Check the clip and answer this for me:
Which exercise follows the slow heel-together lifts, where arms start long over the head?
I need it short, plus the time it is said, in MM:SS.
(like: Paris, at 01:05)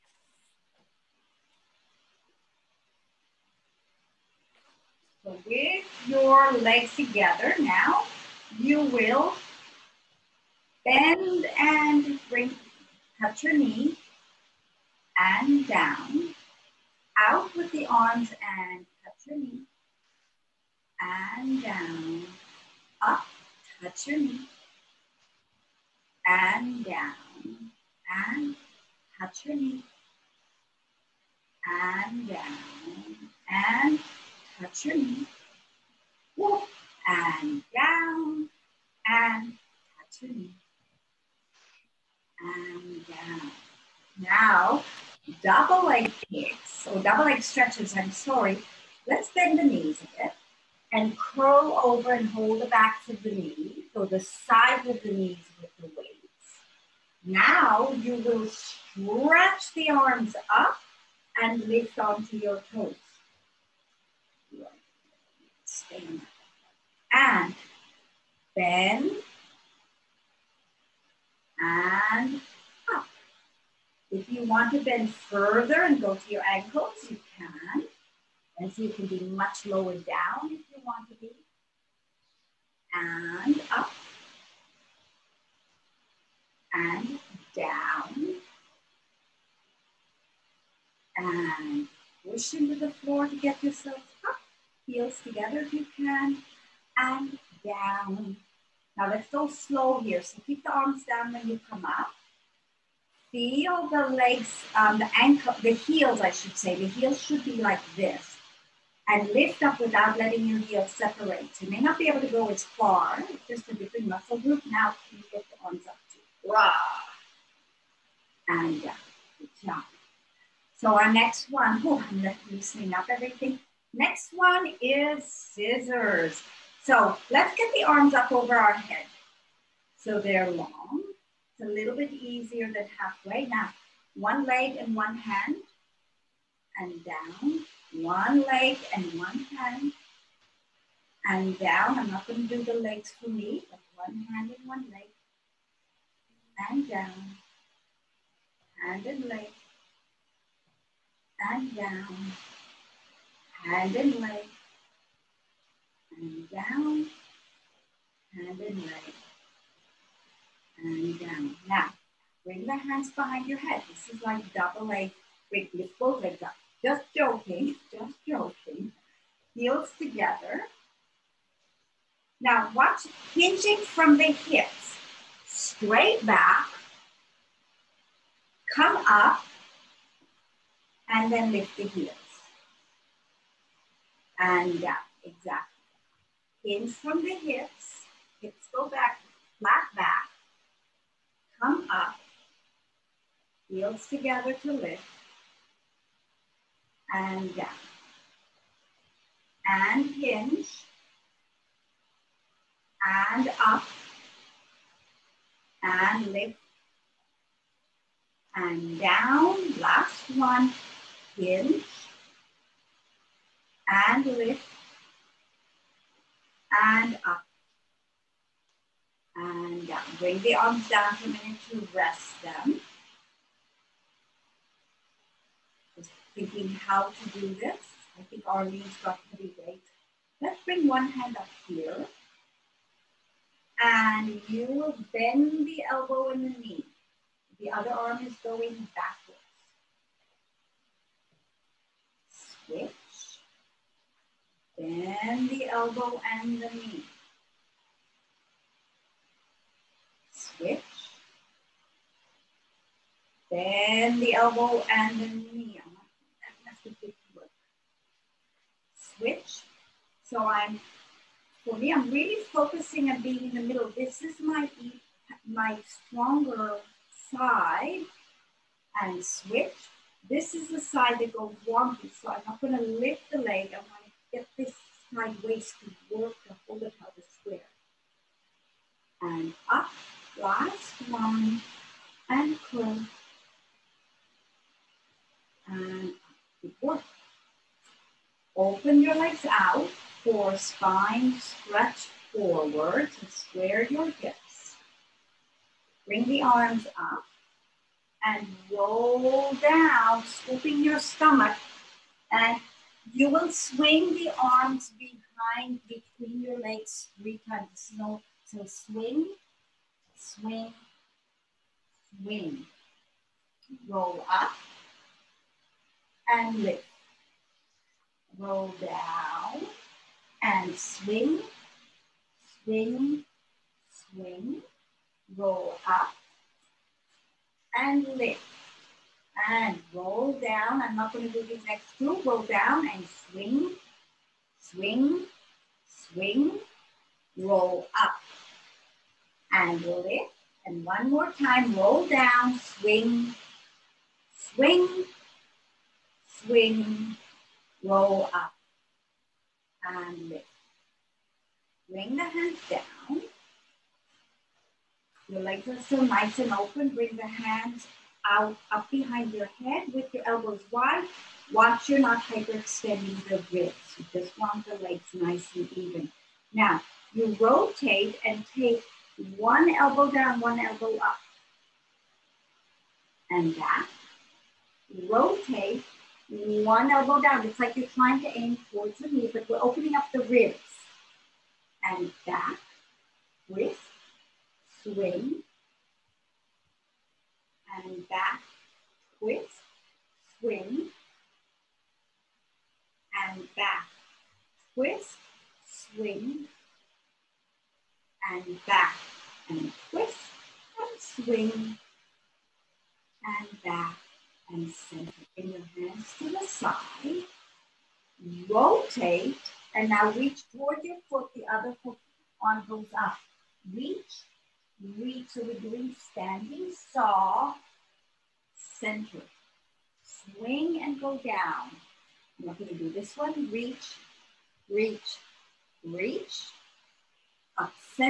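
scissors, at 02:05.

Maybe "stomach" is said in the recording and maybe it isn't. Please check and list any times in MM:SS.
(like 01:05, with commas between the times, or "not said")
05:00.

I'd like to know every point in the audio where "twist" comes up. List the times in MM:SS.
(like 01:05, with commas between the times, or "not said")
06:29, 06:34, 06:39.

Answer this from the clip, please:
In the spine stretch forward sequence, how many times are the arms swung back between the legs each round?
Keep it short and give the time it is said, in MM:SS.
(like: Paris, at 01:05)
3, at 05:07.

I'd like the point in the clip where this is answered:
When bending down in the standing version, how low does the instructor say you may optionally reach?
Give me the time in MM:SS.
01:16.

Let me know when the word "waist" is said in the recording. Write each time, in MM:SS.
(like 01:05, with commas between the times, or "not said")
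04:35.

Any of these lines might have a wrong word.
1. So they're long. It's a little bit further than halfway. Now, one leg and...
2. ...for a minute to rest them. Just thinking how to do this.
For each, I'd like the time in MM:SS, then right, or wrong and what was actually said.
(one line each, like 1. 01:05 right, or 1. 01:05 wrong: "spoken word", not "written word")
1. 02:09 wrong: "easier", not "further"
2. 03:41 right.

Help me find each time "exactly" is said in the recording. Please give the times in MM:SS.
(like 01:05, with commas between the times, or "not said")
03:05.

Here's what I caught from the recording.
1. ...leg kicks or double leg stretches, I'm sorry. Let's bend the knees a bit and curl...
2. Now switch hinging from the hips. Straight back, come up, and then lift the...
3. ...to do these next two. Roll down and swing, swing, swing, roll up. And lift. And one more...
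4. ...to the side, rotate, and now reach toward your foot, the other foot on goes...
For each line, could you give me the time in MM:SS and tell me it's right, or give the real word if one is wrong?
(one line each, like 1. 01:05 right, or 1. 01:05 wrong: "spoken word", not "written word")
1. 00:45 right
2. 02:52 wrong: "watch", not "switch"
3. 05:31 right
4. 06:46 right.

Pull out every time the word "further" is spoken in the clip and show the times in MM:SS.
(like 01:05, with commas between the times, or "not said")
01:15.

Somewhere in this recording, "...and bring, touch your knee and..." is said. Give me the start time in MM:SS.
00:11.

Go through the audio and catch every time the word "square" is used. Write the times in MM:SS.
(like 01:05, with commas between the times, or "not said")
04:37, 04:53.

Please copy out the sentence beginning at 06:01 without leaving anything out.
Watch you're not hyperextending the ribs.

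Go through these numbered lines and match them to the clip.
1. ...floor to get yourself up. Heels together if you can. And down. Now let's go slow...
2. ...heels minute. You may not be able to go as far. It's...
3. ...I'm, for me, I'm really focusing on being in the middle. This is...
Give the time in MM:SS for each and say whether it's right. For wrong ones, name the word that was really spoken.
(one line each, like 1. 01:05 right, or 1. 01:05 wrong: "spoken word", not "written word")
1. 01:32 right
2. 01:50 wrong: "separate", not "minute"
3. 04:20 right.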